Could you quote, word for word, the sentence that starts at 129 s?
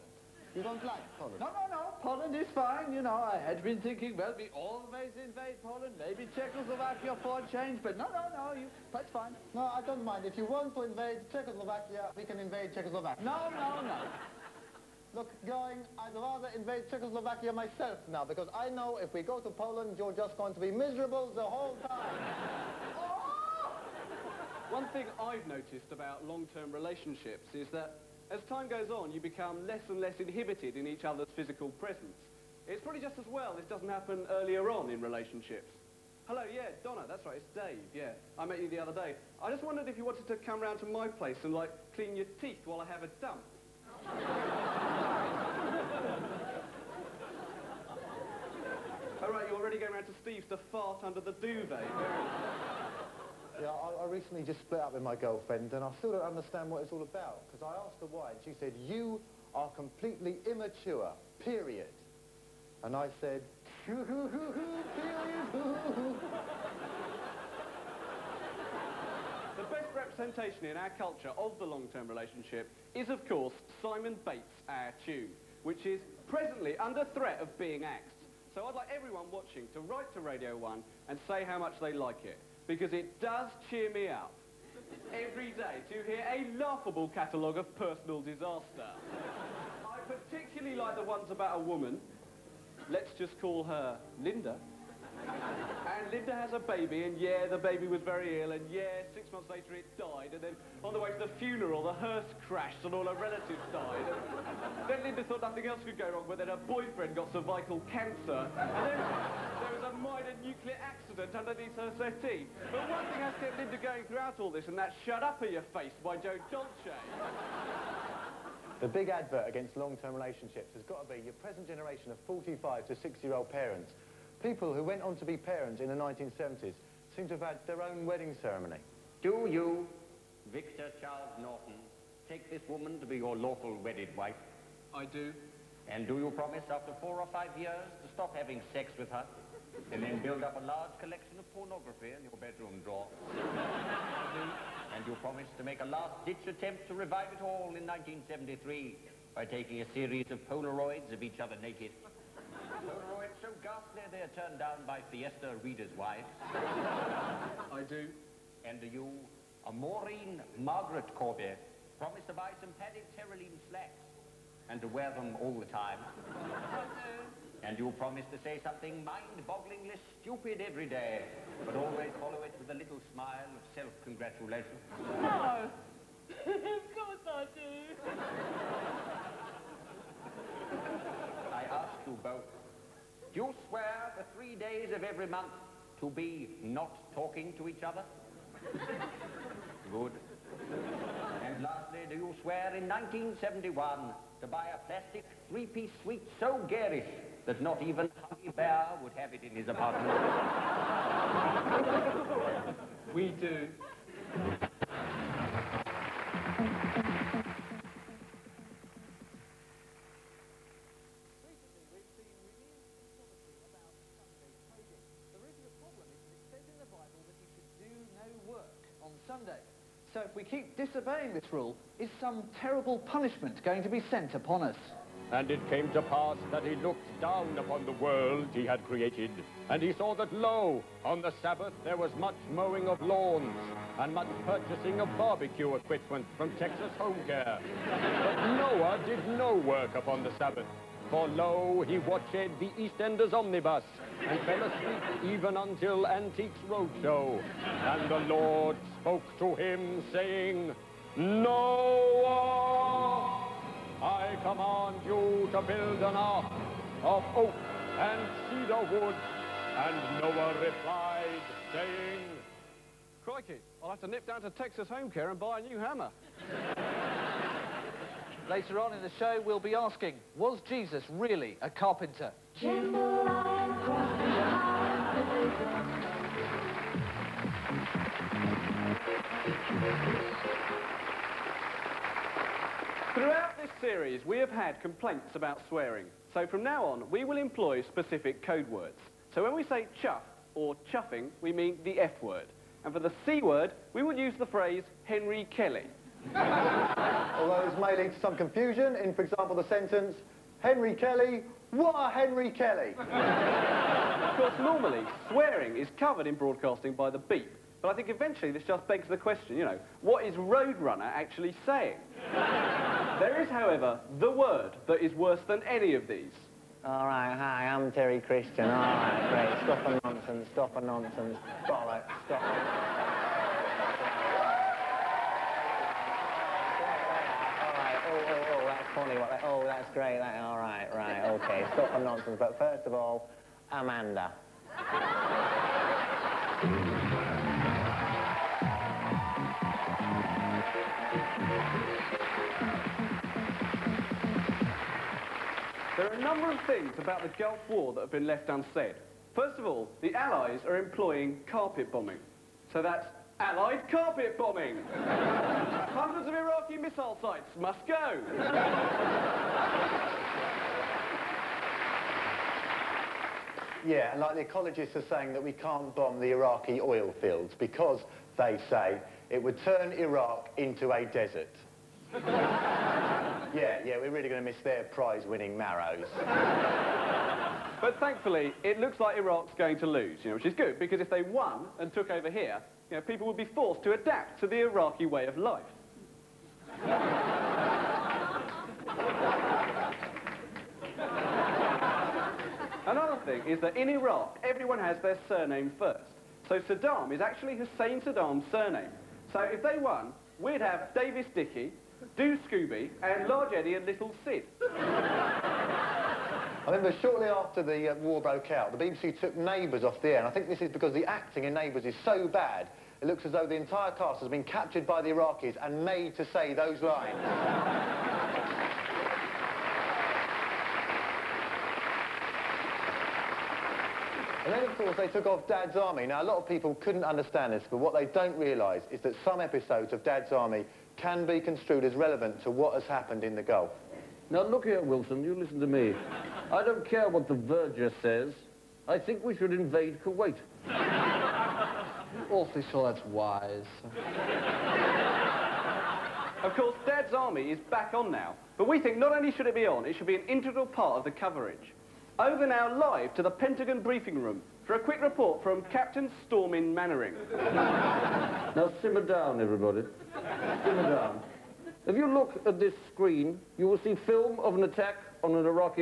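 Do you, Victor Charles Norton, take this woman to be your lawful wedded wife?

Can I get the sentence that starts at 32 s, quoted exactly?
It's probably just as well this doesn't happen earlier on in relationships.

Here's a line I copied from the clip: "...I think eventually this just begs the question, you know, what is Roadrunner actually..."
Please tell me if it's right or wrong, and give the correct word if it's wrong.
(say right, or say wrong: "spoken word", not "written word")
right.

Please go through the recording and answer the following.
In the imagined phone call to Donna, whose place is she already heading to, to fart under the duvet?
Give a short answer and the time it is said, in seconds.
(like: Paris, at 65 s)
Steve's, at 50 s.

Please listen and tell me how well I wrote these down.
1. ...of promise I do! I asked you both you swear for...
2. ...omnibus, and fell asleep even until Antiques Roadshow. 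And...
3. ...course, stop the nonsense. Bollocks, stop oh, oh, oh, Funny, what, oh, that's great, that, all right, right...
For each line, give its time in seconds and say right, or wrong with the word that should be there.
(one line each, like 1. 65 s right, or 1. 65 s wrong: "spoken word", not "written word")
1. 176 s wrong: "course", not "promise"
2. 243 s right
3. 320 s wrong: "nonsense", not "course".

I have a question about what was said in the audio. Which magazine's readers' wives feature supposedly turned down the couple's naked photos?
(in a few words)
Fiesta.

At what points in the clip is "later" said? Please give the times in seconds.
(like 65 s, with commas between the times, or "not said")
99 s, 268 s.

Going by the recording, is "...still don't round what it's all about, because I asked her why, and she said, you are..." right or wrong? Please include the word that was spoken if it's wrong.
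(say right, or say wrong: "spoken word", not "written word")
wrong: "understand", not "round".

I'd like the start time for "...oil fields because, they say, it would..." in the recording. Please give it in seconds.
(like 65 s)
366 s.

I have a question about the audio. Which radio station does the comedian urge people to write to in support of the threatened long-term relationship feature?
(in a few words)
Radio 1.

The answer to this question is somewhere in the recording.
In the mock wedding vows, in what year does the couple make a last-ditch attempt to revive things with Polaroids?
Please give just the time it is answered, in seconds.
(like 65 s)
147 s.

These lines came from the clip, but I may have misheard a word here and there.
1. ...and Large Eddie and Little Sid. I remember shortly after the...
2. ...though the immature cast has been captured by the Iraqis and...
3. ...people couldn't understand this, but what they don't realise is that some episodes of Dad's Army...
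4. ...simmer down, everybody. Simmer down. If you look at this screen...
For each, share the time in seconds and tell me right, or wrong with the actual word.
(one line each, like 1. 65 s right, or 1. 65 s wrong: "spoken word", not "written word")
1. 403 s right
2. 413 s wrong: "entire", not "immature"
3. 426 s right
4. 458 s right.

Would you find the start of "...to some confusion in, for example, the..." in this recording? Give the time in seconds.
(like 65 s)
298 s.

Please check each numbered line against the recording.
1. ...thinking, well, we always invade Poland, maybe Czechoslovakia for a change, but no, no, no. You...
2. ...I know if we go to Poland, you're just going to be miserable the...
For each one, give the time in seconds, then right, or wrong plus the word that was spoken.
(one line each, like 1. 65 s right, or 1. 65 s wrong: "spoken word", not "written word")
1. 3 s right
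2. 18 s right.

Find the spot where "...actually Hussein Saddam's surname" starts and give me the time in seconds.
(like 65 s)
397 s.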